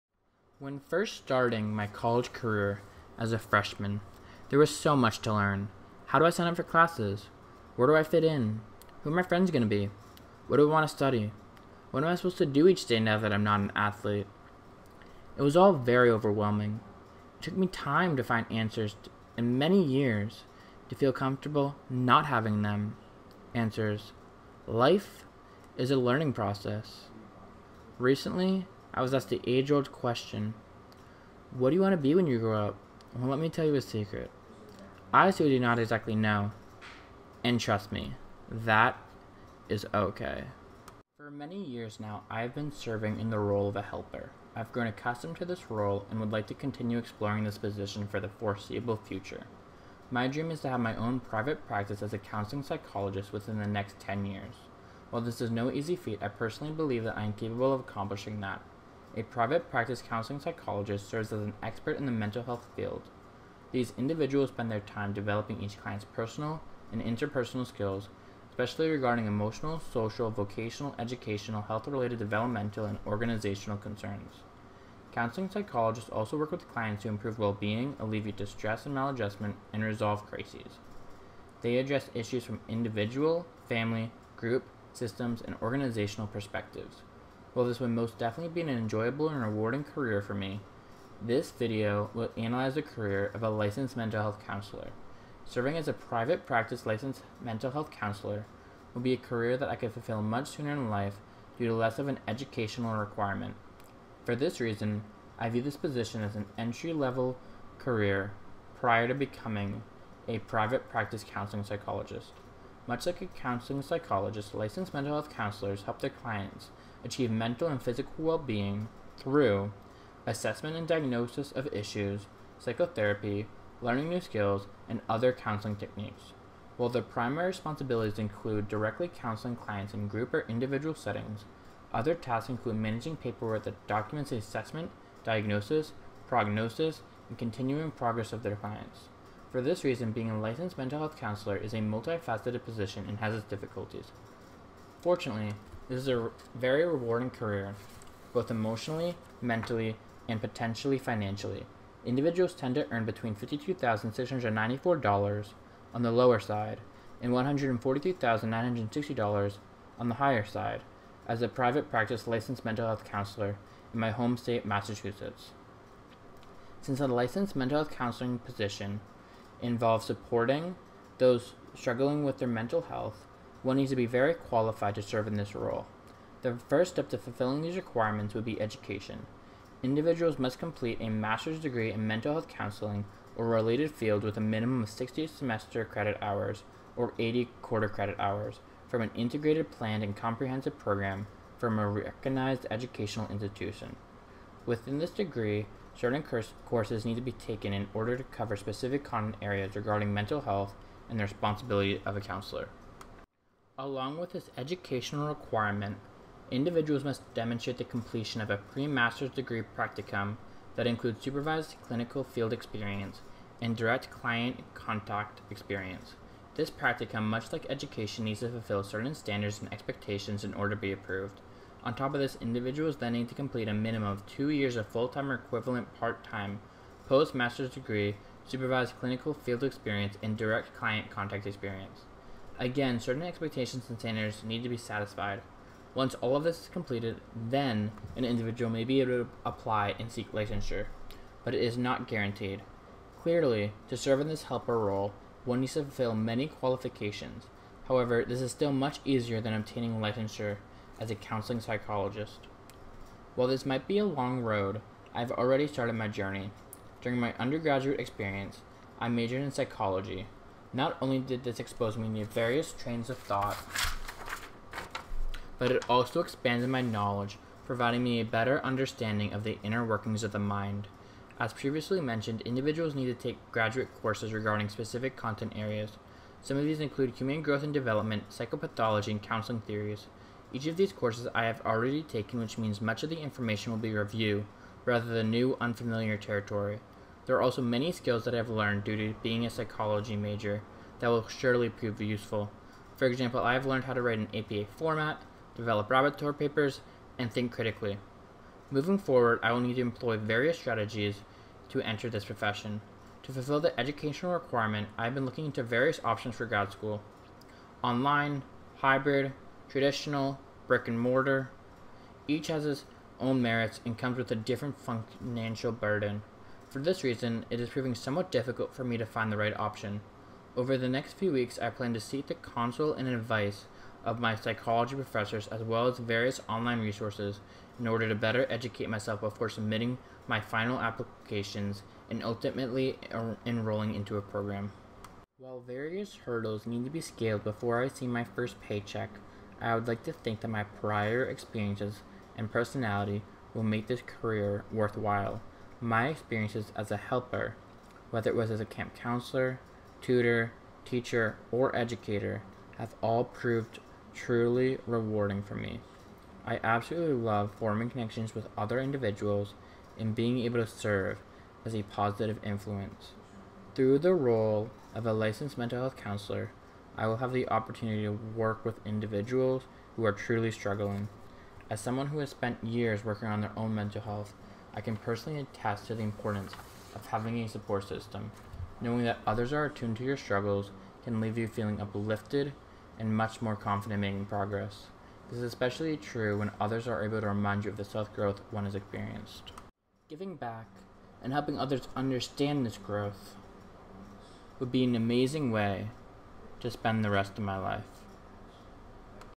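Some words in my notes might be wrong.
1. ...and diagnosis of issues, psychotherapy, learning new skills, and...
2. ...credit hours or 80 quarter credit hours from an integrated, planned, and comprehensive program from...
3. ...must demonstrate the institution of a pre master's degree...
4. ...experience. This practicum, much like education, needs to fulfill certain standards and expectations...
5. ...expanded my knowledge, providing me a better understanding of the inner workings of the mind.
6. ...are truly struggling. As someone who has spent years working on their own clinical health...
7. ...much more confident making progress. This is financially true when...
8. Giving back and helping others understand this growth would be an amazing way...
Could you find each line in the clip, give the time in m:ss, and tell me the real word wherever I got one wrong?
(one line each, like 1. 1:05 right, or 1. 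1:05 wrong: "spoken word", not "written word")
1. 2:00 right
2. 3:05 right
3. 3:27 wrong: "completion", not "institution"
4. 3:35 right
5. 4:26 right
6. 6:10 wrong: "mental", not "clinical"
7. 6:23 wrong: "especially", not "financially"
8. 6:30 right.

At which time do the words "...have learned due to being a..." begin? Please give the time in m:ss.
4:48.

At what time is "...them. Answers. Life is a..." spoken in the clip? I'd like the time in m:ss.
0:22.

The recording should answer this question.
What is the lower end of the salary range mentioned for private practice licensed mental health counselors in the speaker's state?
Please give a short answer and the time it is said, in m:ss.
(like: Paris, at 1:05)
$52,694, at 2:33.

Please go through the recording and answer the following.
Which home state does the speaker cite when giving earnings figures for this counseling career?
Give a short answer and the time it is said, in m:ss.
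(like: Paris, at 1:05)
Massachusetts, at 2:44.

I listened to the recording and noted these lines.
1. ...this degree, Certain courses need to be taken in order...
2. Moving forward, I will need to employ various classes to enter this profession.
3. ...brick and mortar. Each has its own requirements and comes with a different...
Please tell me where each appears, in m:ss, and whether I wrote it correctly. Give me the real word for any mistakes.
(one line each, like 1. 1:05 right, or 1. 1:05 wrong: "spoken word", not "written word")
1. 3:14 right
2. 4:58 wrong: "strategies", not "classes"
3. 5:10 wrong: "merits", not "requirements".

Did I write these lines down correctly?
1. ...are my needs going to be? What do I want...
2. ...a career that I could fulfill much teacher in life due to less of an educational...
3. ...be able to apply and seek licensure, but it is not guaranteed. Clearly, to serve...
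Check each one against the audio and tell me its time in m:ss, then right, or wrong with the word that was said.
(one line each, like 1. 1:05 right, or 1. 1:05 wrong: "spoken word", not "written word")
1. 0:09 wrong: "friends", not "needs"
2. 1:39 wrong: "sooner", not "teacher"
3. 3:58 right.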